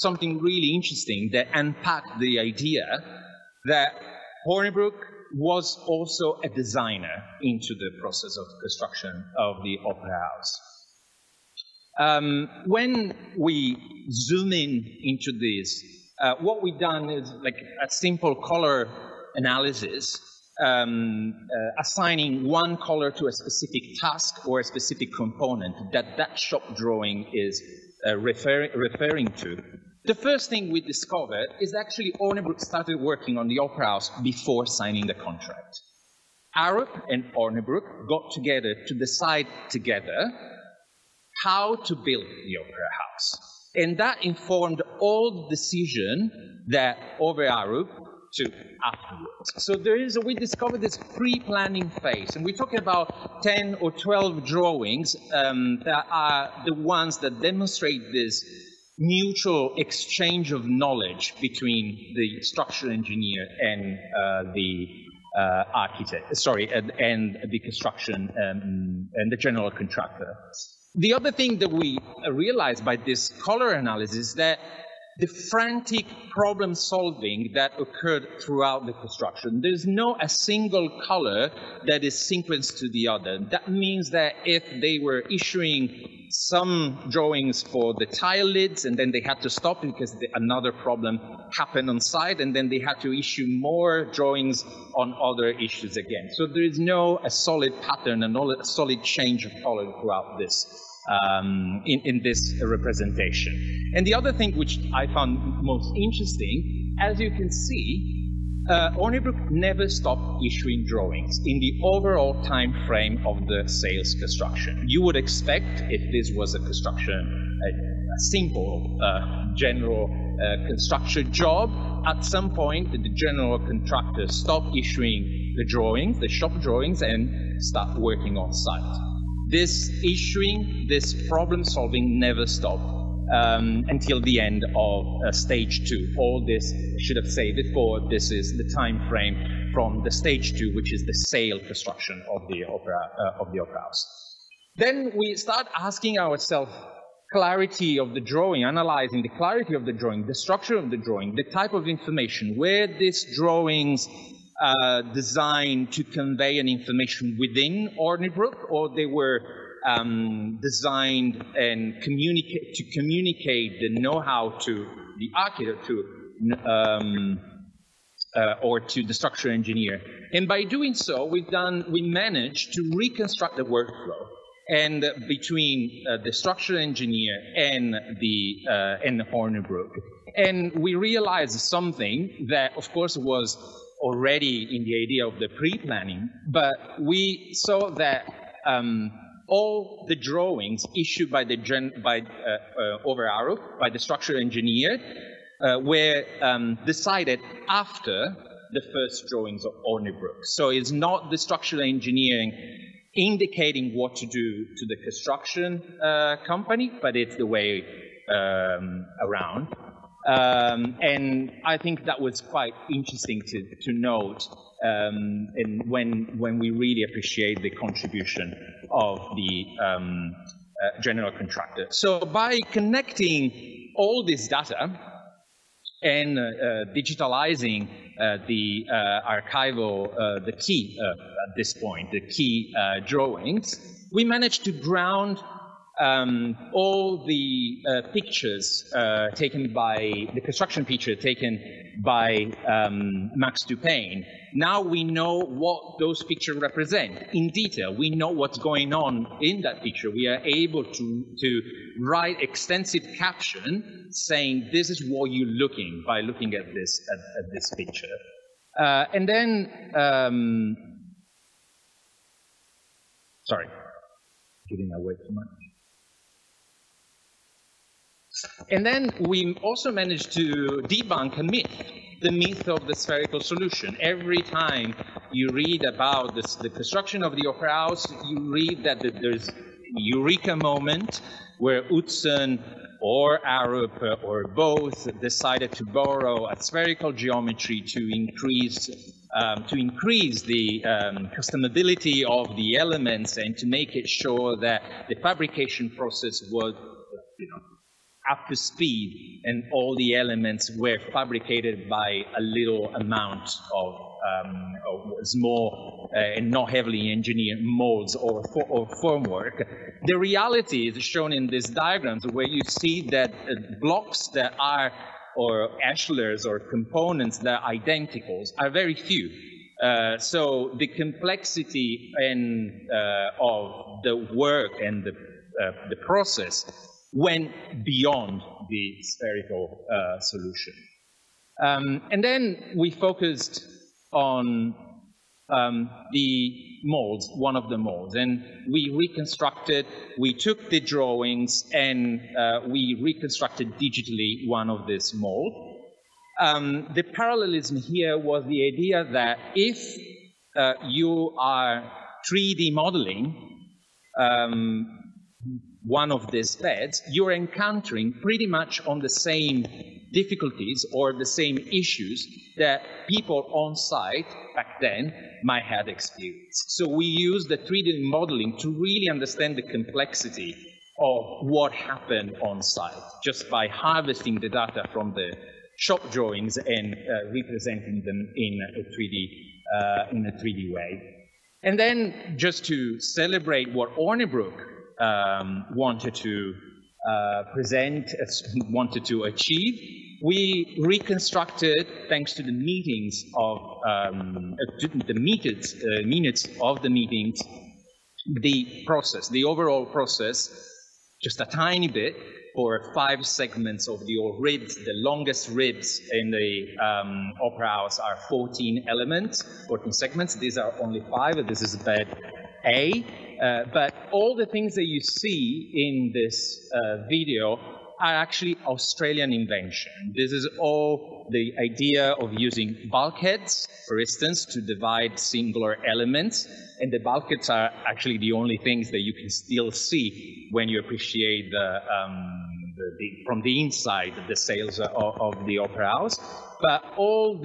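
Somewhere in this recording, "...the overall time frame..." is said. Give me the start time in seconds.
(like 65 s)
111 s.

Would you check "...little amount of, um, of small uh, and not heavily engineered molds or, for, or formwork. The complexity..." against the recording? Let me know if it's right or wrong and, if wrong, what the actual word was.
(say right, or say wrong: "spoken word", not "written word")
wrong: "reality", not "complexity".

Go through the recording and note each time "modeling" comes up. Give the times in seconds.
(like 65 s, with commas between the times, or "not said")
352 s, 368 s.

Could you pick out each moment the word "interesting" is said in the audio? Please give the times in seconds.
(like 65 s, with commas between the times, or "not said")
0 s, 105 s, 212 s.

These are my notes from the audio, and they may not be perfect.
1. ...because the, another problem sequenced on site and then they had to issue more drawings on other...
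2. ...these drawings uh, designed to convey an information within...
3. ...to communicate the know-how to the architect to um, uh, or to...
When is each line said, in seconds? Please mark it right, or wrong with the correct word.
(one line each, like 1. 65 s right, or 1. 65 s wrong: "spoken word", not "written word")
1. 89 s wrong: "happened", not "sequenced"
2. 152 s right
3. 162 s right.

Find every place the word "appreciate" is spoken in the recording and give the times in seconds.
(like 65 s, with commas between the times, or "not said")
217 s, 430 s.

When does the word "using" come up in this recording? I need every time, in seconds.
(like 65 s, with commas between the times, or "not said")
422 s.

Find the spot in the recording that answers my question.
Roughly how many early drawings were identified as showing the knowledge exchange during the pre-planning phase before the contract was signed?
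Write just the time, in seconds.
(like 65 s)
53 s.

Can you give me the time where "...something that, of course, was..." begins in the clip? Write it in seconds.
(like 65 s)
181 s.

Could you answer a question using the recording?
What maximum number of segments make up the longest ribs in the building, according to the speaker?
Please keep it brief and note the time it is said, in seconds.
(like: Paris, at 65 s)
14, at 408 s.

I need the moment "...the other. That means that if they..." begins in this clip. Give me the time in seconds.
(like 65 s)
82 s.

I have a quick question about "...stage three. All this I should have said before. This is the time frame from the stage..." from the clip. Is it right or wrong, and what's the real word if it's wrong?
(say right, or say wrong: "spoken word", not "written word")
wrong: "two", not "three".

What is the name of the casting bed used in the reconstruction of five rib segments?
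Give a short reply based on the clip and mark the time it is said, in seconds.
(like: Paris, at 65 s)
bed A, at 411 s.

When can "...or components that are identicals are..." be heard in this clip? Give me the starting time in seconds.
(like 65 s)
316 s.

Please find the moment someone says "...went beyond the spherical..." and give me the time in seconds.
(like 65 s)
327 s.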